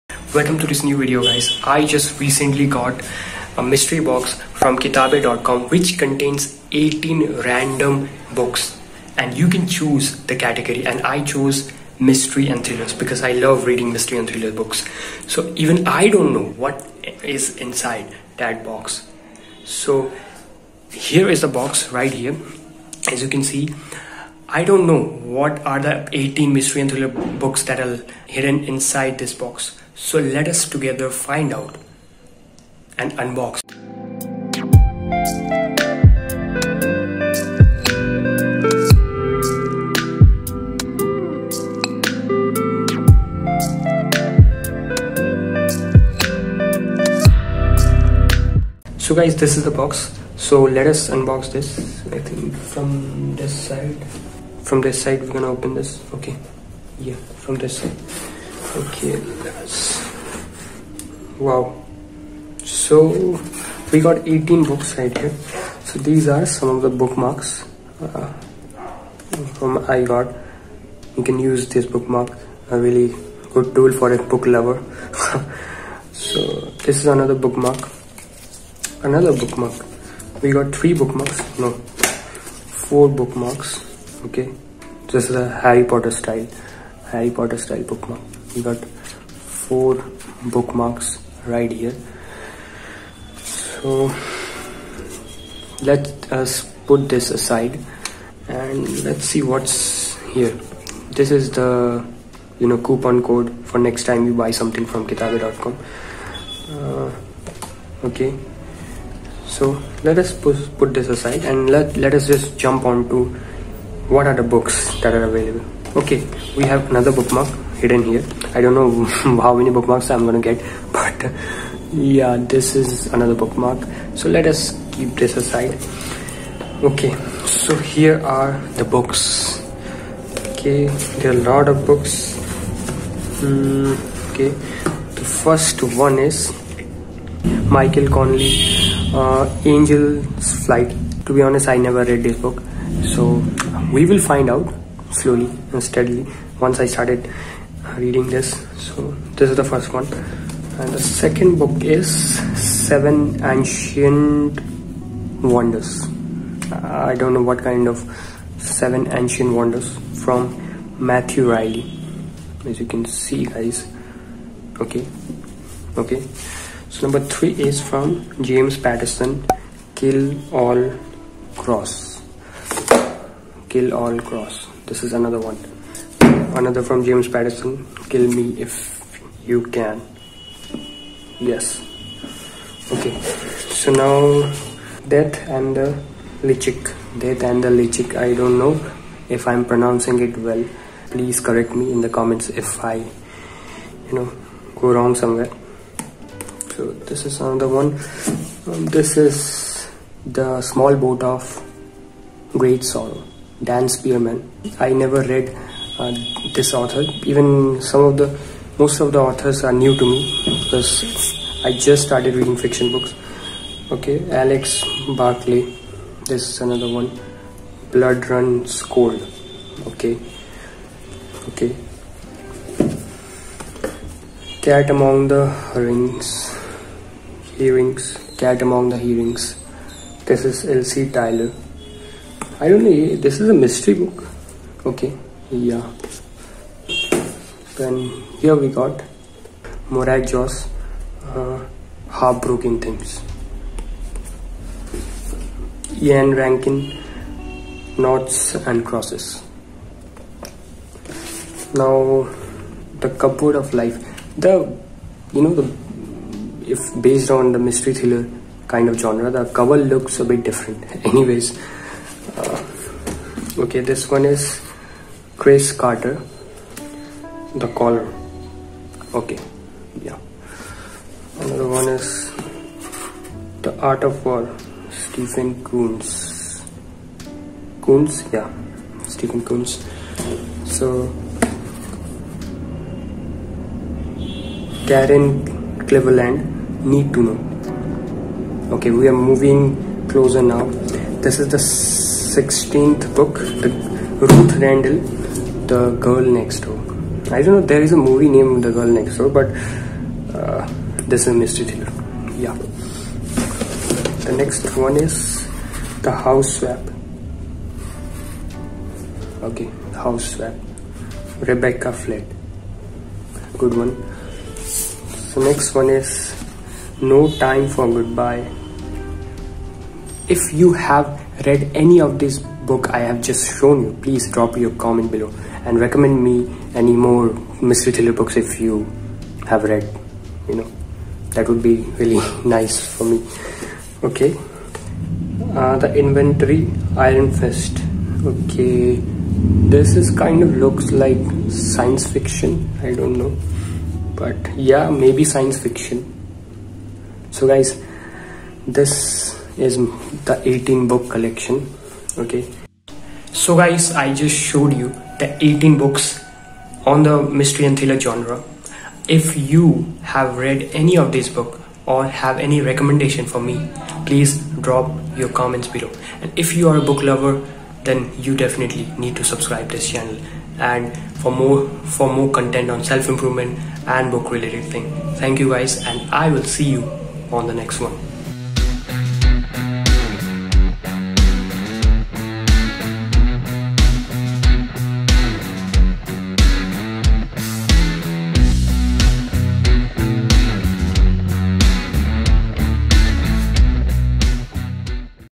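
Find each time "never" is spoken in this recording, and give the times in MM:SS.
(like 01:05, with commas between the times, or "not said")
02:21, 03:24.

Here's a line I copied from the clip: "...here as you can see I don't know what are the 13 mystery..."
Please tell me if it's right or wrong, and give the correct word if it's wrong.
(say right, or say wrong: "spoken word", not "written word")
wrong: "18", not "13".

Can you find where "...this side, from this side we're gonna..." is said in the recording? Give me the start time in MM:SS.
00:53.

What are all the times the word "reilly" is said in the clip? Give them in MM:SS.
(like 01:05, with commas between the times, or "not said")
02:41.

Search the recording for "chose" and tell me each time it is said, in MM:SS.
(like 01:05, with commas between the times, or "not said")
00:11.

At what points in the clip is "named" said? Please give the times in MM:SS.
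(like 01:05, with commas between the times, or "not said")
04:58.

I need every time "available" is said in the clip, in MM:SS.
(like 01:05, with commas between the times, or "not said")
01:55.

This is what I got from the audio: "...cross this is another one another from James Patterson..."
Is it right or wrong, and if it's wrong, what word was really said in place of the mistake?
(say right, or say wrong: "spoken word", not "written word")
right.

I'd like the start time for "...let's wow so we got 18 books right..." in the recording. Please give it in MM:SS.
00:59.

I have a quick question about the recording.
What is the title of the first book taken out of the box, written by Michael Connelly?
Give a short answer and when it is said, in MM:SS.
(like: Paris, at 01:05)
Angel's Flight, at 02:19.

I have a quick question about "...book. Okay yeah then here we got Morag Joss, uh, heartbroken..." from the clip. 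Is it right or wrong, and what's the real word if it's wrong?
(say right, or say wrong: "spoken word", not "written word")
right.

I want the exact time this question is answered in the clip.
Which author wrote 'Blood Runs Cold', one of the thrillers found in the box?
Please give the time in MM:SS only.
03:34.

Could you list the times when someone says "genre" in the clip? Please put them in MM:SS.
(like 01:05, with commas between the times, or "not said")
04:18, 05:57.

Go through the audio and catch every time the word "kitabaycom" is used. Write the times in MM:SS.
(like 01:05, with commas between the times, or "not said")
00:04, 01:45.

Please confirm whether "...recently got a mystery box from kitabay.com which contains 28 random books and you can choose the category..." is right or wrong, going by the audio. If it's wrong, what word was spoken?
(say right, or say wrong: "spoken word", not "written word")
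wrong: "18", not "28".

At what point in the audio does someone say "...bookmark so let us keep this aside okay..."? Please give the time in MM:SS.
02:03.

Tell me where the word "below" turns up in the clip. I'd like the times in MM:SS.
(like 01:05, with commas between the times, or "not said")
05:25, 06:05.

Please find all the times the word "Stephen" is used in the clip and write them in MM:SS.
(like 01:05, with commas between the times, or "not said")
04:34, 04:39.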